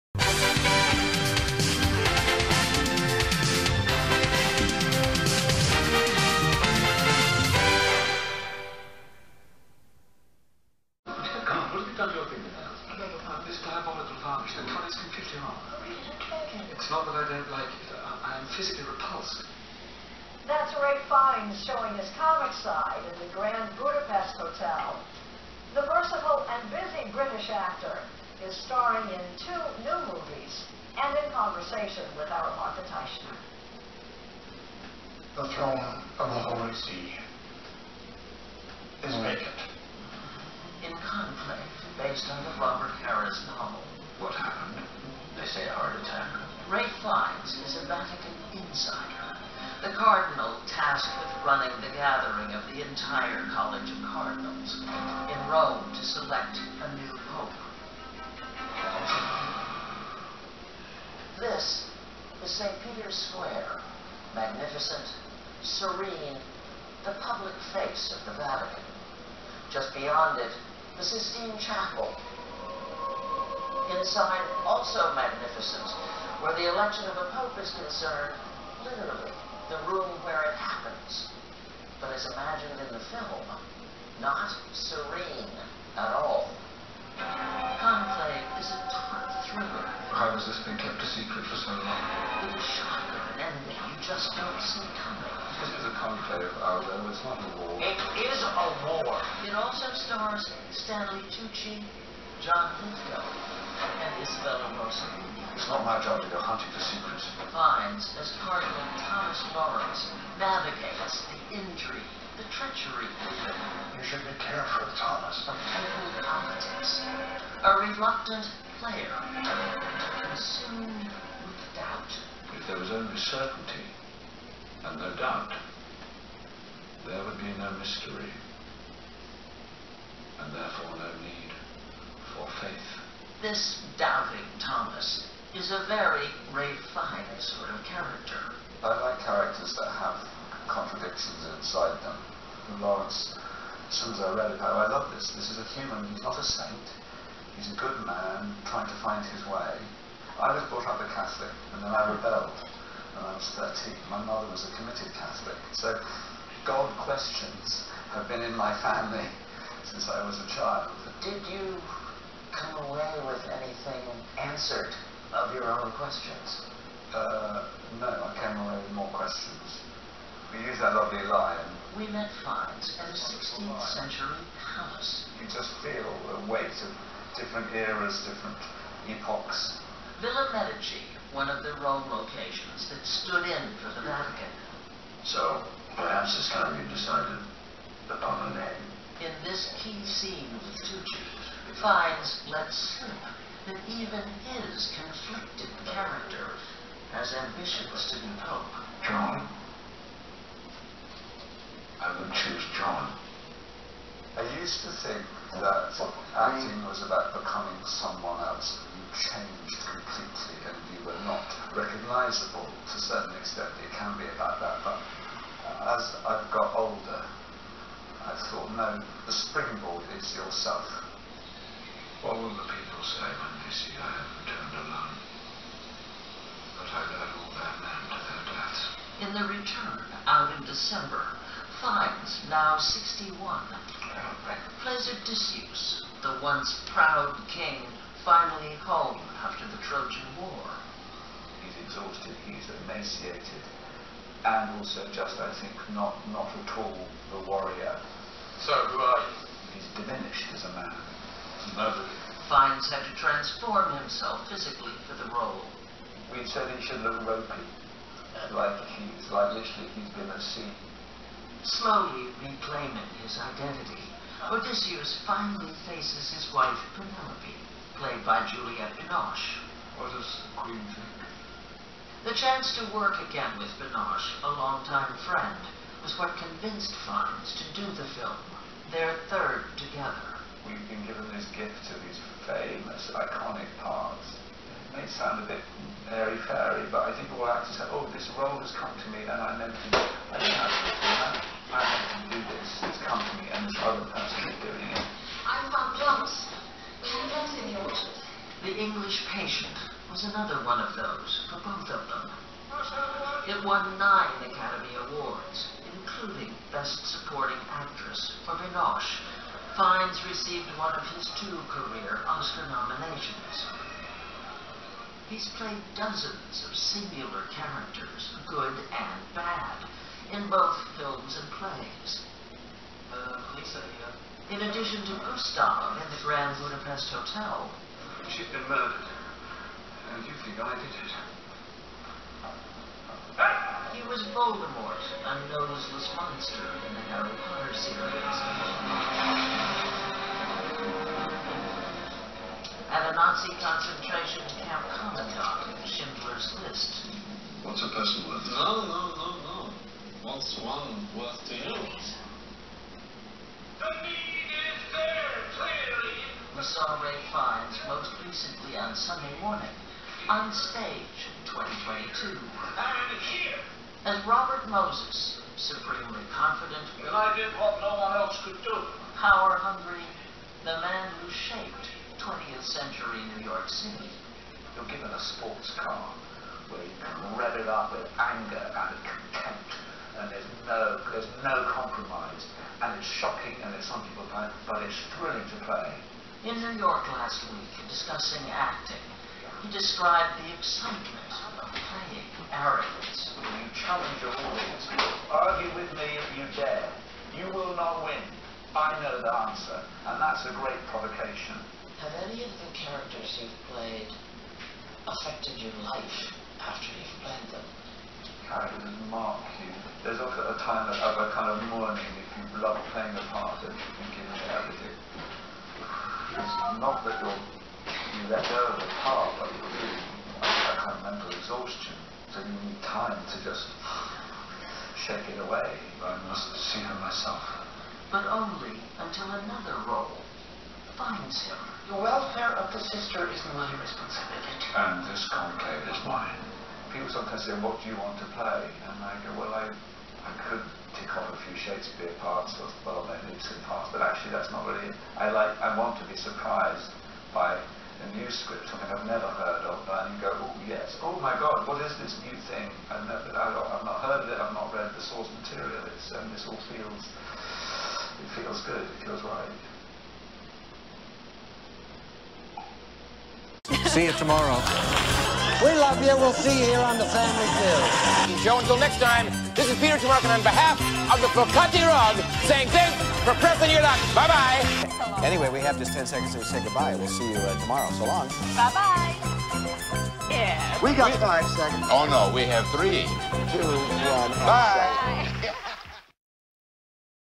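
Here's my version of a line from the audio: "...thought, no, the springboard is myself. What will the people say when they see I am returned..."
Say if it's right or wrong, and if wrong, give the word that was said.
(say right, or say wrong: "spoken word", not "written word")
wrong: "yourself", not "myself".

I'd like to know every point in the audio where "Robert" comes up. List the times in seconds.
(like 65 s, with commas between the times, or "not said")
42 s, 364 s.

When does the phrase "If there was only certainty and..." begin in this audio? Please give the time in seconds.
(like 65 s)
122 s.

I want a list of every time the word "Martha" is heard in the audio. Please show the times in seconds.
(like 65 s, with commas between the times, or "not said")
32 s.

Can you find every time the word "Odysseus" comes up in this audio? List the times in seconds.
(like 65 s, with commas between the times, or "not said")
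235 s, 264 s.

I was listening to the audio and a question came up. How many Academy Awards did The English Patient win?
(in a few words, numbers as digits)
9.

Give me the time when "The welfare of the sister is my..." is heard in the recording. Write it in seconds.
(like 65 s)
431 s.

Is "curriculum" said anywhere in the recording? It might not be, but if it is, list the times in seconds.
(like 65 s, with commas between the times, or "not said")
not said.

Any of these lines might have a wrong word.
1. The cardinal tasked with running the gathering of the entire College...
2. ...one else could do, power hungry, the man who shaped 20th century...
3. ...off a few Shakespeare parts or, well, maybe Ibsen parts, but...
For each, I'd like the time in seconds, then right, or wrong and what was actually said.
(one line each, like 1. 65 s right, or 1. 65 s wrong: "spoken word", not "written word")
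1. 49 s right
2. 368 s right
3. 441 s right.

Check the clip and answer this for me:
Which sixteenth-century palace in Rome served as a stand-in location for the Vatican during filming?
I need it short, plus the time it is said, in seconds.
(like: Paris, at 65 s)
Villa Medici, at 180 s.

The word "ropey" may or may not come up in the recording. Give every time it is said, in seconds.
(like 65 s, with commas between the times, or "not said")
257 s.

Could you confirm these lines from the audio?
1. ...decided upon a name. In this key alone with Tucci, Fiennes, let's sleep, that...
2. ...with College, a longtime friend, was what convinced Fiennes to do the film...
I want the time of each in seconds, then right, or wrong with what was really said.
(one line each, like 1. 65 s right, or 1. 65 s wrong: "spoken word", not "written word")
1. 186 s wrong: "scene", not "alone"
2. 273 s wrong: "Binoche", not "College".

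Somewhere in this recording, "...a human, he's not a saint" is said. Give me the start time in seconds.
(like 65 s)
145 s.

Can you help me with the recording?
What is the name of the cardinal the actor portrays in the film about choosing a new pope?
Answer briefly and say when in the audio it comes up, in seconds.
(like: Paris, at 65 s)
Thomas Lawrence, at 109 s.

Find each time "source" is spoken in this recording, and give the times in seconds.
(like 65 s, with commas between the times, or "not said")
455 s.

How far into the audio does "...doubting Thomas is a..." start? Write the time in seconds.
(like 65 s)
133 s.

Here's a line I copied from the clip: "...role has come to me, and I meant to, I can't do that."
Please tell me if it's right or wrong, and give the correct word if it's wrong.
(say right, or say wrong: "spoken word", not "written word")
right.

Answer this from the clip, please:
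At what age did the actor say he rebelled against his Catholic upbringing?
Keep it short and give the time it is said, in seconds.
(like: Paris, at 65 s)
13, at 153 s.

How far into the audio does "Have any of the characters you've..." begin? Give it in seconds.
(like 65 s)
402 s.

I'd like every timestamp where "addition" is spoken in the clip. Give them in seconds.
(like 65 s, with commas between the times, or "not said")
324 s.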